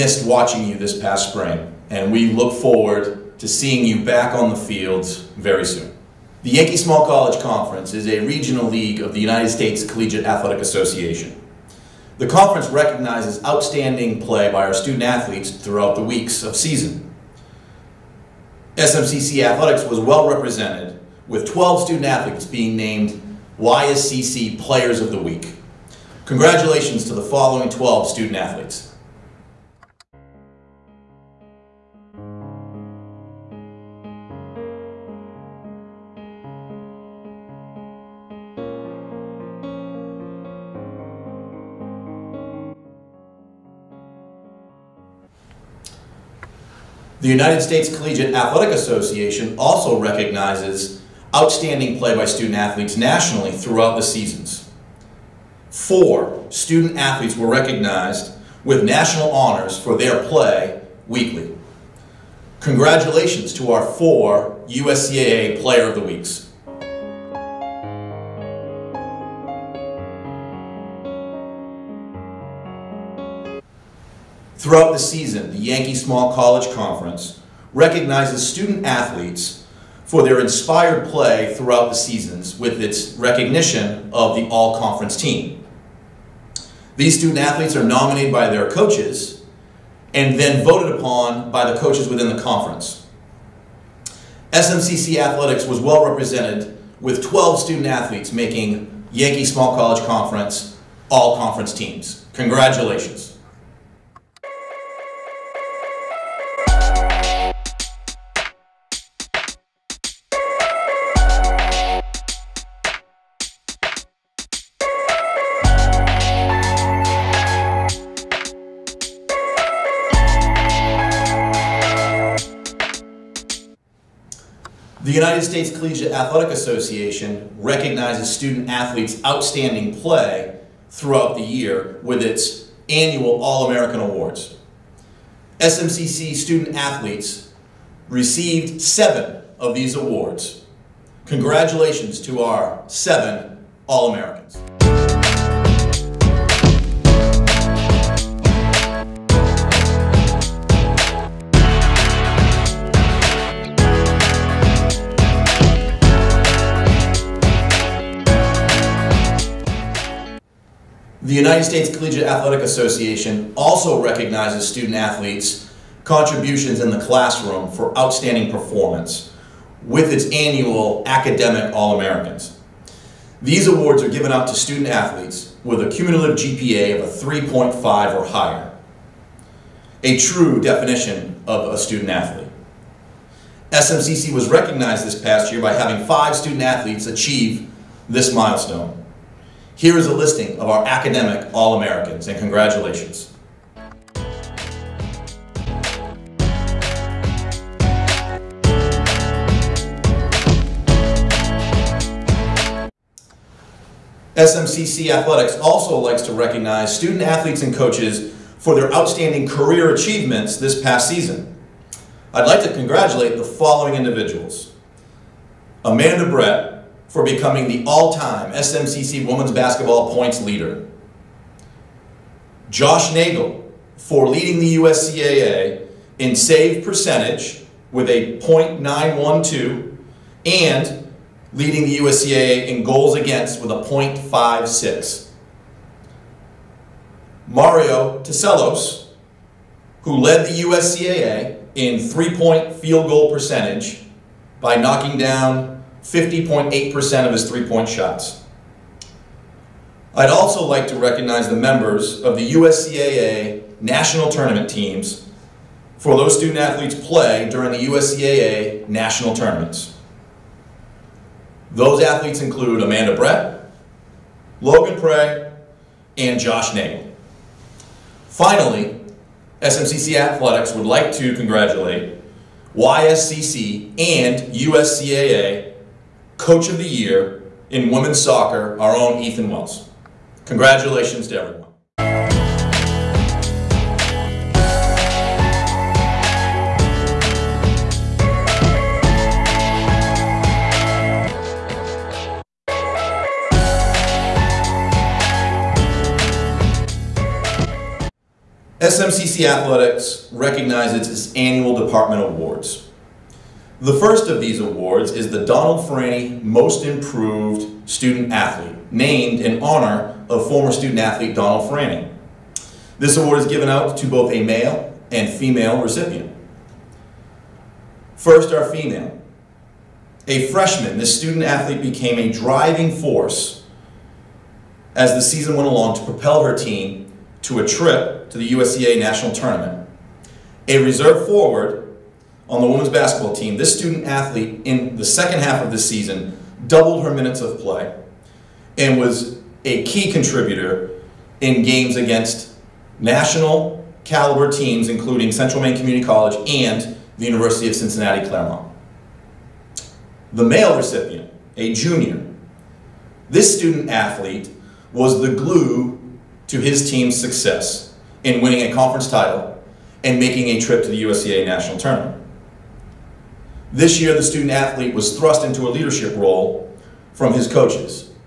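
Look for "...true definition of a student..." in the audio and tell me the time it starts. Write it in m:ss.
3:00.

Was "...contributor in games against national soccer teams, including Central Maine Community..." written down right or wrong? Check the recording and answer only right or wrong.
wrong.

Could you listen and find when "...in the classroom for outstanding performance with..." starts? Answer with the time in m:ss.
2:46.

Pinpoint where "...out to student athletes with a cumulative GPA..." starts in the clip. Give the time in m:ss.
2:54.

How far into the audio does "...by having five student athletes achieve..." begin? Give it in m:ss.
3:05.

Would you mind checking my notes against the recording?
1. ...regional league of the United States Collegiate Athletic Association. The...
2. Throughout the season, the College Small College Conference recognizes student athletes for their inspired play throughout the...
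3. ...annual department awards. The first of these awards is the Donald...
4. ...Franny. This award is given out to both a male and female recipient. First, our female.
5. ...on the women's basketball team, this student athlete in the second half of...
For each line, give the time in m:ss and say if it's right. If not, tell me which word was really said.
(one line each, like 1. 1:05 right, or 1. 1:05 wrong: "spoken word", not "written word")
1. 0:08 right
2. 1:14 wrong: "Yankee", not "College"
3. 5:01 right
4. 5:11 right
5. 5:32 right.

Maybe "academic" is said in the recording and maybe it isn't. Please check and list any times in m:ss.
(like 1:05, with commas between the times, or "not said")
2:51, 3:10.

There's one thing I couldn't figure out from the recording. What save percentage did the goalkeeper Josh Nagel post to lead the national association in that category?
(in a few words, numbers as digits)
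.912.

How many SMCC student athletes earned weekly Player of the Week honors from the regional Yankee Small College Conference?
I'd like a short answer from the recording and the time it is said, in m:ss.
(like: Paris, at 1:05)
12, at 0:21.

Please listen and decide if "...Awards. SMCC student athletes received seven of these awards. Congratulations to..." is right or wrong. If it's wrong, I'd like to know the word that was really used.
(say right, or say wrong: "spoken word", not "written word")
right.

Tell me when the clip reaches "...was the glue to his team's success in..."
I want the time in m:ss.
5:54.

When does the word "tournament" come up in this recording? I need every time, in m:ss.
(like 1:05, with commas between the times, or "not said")
4:14, 4:19, 5:29, 6:01.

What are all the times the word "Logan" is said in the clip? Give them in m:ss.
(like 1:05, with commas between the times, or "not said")
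4:24.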